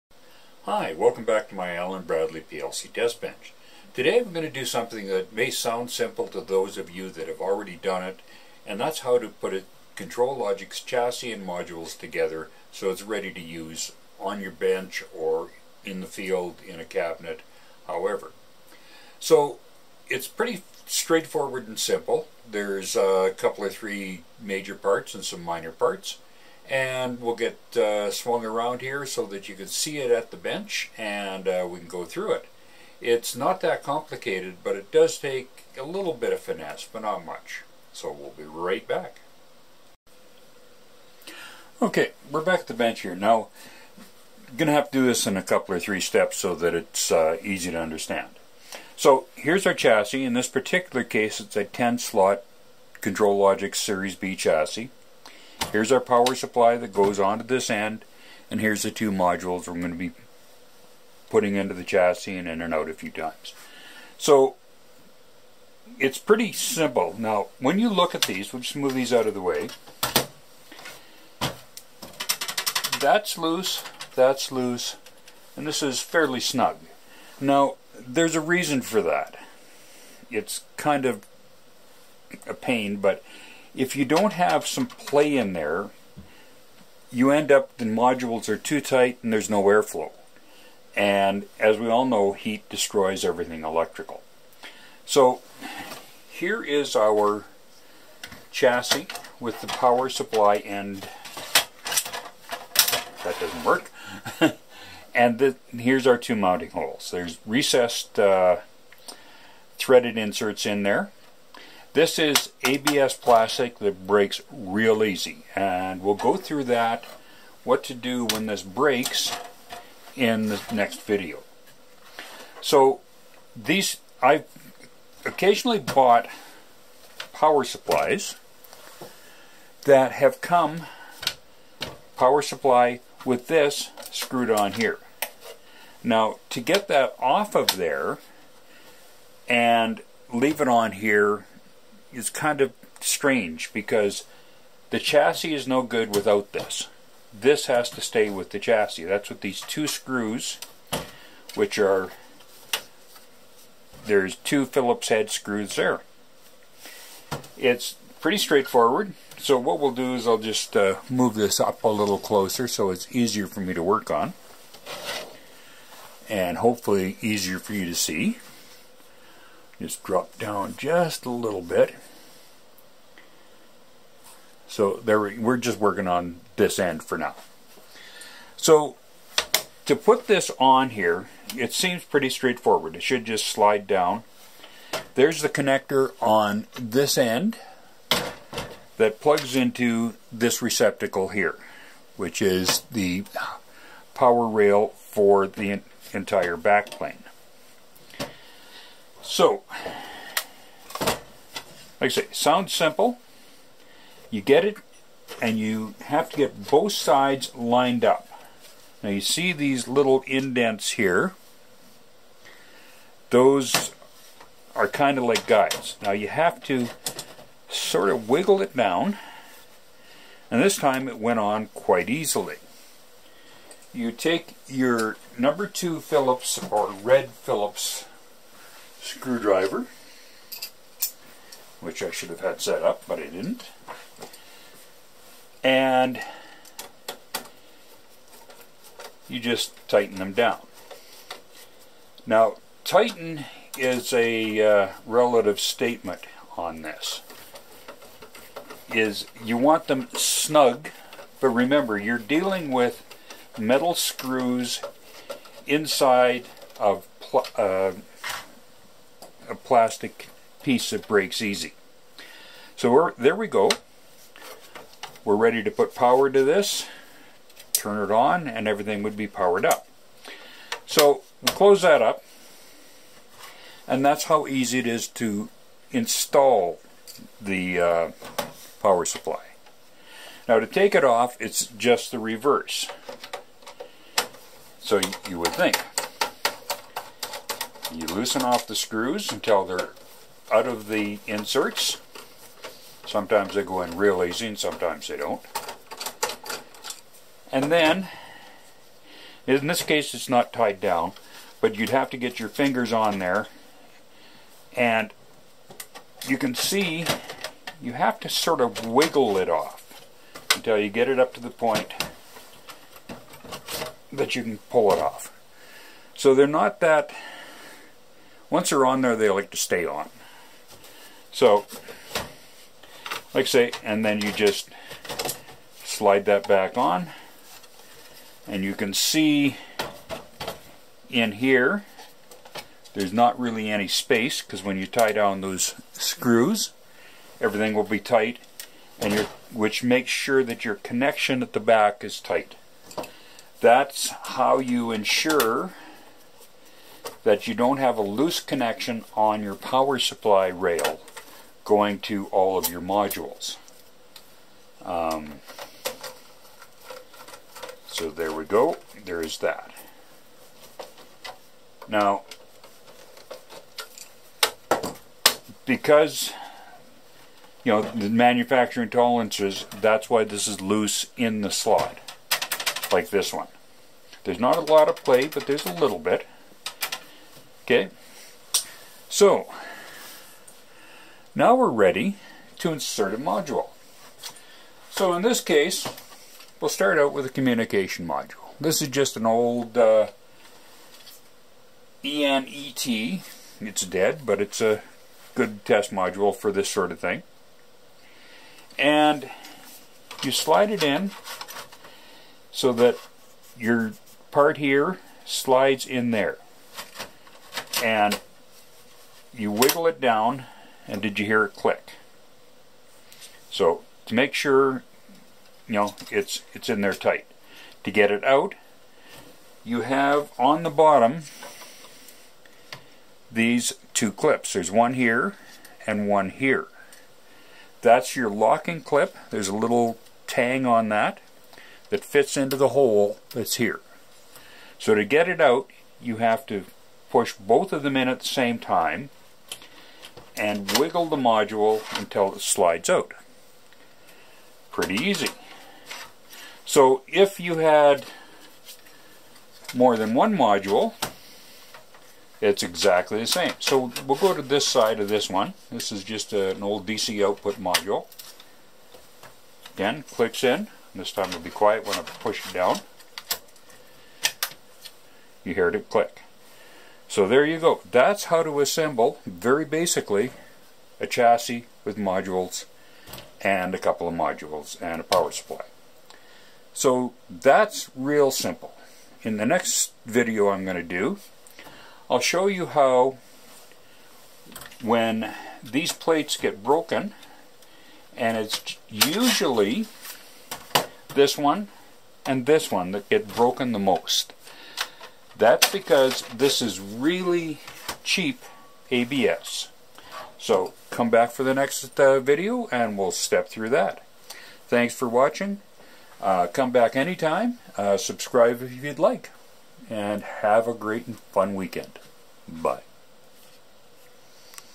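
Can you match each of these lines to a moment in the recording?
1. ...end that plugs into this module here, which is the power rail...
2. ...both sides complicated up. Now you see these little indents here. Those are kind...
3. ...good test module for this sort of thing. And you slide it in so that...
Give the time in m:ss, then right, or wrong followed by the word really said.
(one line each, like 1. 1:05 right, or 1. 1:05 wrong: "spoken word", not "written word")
1. 3:07 wrong: "receptacle", not "module"
2. 3:26 wrong: "lined", not "complicated"
3. 6:35 right.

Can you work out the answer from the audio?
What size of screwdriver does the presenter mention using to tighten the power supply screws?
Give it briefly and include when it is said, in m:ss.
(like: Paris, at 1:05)
Number two Phillips, at 3:45.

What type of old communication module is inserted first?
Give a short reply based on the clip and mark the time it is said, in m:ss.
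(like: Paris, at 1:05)
ENET, at 6:32.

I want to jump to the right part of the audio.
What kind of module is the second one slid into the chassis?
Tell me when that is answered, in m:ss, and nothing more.
7:36.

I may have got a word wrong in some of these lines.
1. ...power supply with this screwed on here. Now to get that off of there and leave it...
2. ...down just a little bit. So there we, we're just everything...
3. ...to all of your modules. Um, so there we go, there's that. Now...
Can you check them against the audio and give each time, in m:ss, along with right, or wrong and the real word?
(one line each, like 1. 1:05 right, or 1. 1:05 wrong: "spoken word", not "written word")
1. 2:12 right
2. 2:50 wrong: "working", not "everything"
3. 5:51 right.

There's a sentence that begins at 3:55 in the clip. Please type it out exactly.
And you just tighten them down.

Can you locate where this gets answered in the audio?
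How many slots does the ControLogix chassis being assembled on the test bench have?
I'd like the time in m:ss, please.
0:51.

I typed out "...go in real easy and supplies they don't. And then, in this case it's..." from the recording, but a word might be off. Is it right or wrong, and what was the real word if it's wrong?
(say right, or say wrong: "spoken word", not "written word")
wrong: "sometimes", not "supplies".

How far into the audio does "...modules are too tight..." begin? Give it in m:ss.
1:27.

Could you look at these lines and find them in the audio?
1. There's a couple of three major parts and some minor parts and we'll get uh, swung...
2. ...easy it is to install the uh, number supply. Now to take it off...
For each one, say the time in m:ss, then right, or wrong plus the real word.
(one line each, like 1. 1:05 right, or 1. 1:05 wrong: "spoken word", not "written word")
1. 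0:22 right
2. 4:34 wrong: "power", not "number".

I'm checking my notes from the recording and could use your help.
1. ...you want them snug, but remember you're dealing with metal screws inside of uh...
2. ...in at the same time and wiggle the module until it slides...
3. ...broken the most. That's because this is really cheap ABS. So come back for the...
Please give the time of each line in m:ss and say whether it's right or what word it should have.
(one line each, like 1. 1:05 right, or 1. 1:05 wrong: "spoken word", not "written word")
1. 4:09 right
2. 7:17 right
3. 8:13 right.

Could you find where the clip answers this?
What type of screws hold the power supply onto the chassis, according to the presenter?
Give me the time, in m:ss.
2:34.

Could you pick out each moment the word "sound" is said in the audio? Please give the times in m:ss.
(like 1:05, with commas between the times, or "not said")
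0:05, 3:22.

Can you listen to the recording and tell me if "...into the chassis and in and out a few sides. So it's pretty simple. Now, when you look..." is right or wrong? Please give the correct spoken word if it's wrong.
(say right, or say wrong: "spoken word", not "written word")
wrong: "times", not "sides".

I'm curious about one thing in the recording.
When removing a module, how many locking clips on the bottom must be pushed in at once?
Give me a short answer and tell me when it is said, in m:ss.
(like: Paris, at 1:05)
2, at 7:03.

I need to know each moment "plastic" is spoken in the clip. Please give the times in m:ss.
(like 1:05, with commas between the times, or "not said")
1:53, 4:19.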